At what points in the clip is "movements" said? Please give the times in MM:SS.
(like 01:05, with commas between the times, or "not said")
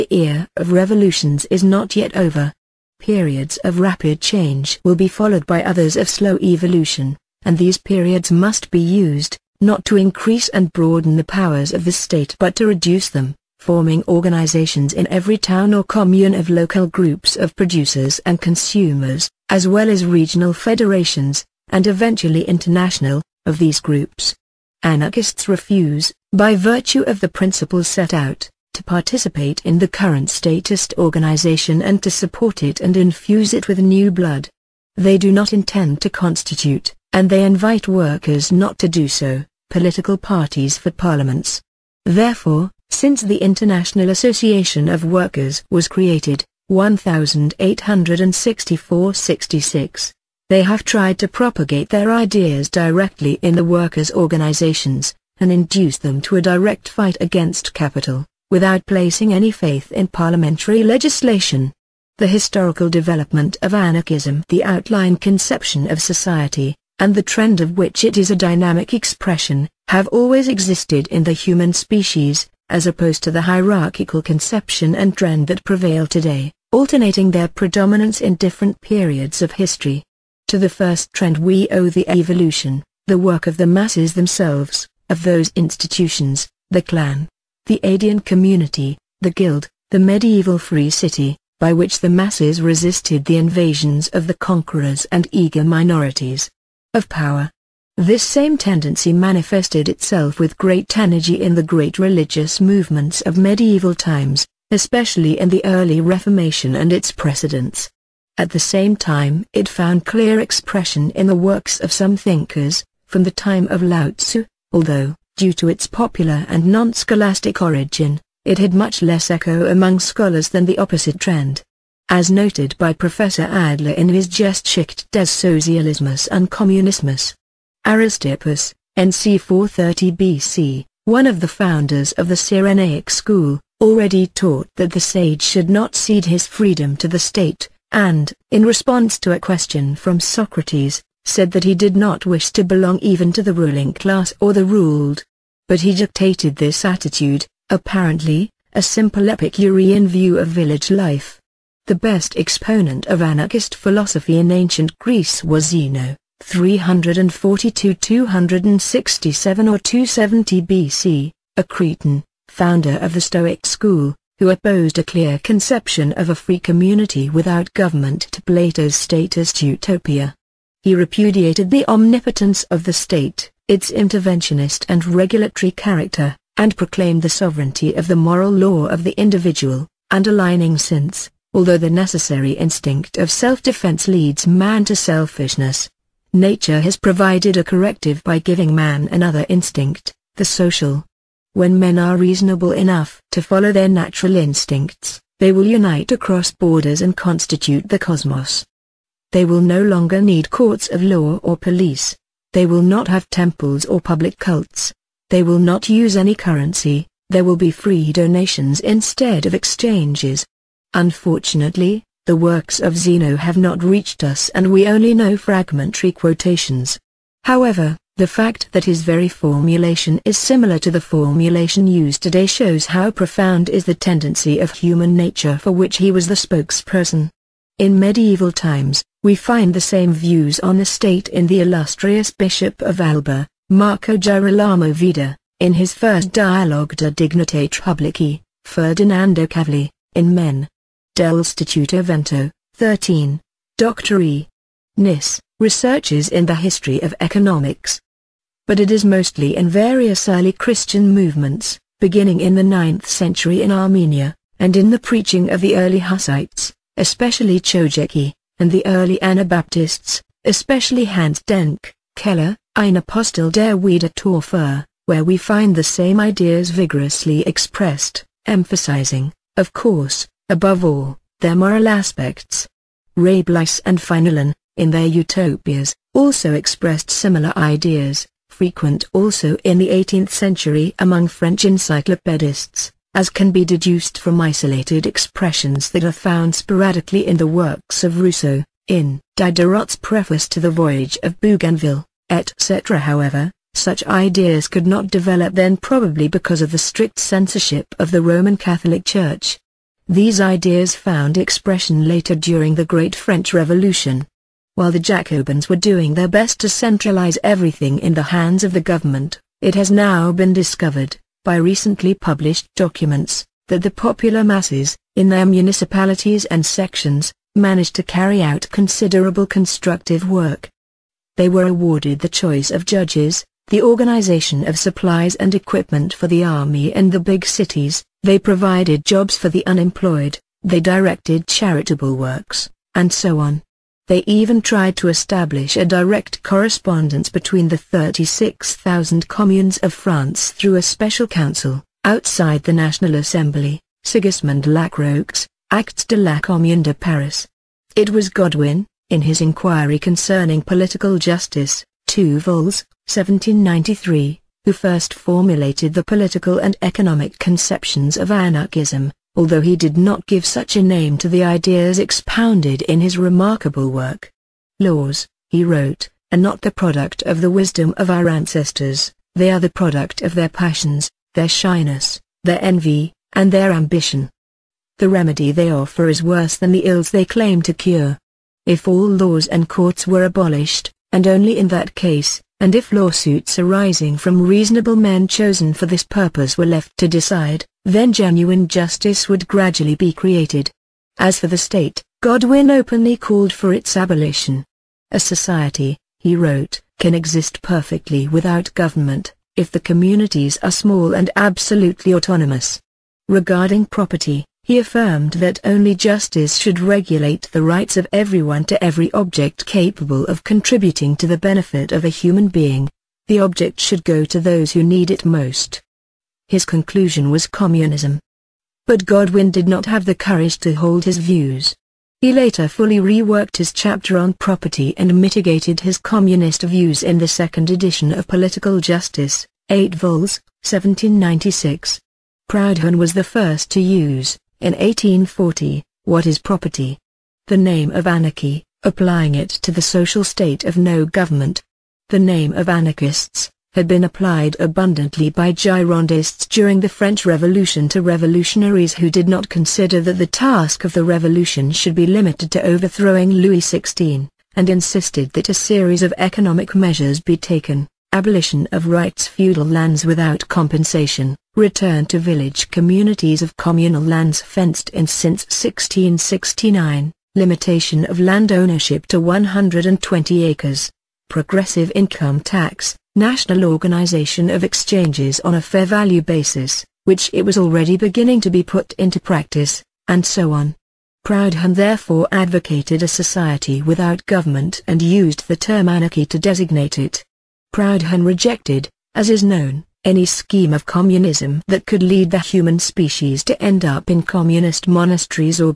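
01:42, 04:11.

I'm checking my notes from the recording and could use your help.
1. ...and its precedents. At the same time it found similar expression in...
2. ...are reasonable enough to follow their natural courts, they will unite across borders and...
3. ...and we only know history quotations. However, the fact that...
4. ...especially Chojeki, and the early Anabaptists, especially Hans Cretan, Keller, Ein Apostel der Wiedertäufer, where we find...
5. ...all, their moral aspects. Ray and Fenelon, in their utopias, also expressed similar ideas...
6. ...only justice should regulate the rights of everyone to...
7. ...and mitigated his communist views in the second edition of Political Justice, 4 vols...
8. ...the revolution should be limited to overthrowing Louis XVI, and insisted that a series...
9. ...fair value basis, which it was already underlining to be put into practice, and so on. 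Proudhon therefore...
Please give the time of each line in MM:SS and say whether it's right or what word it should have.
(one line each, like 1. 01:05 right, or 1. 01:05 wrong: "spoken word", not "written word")
1. 01:46 wrong: "clear", not "similar"
2. 03:11 wrong: "instincts", not "courts"
3. 03:34 wrong: "fragmentary", not "history"
4. 04:16 wrong: "Denck", not "Cretan"
5. 04:30 right
6. 06:45 right
7. 07:04 wrong: "8", not "4"
8. 07:30 right
9. 07:55 wrong: "beginning", not "underlining".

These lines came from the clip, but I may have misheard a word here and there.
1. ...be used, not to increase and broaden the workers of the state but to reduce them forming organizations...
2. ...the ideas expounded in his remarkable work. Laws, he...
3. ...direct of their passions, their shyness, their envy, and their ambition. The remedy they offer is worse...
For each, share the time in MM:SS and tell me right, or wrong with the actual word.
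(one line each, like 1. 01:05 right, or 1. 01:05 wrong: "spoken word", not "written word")
1. 00:08 wrong: "powers", not "workers"
2. 06:01 right
3. 06:09 wrong: "product", not "direct".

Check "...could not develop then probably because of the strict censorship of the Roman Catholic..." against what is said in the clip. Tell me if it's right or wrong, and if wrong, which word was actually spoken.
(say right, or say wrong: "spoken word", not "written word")
right.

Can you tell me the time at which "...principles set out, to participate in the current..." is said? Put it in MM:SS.
00:27.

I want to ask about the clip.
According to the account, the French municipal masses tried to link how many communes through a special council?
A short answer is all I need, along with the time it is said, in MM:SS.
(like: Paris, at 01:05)
36,000, at 05:37.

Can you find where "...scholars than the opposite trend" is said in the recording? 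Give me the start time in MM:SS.
01:59.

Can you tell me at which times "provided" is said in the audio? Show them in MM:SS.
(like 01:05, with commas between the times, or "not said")
03:06, 05:28.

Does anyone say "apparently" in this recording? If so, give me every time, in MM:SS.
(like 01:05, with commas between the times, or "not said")
02:27.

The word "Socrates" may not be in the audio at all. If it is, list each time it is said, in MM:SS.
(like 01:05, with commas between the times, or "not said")
02:20.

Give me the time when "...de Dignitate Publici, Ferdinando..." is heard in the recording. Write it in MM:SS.
03:56.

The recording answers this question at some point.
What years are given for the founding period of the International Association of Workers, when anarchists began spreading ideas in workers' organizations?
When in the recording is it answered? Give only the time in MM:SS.
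00:46.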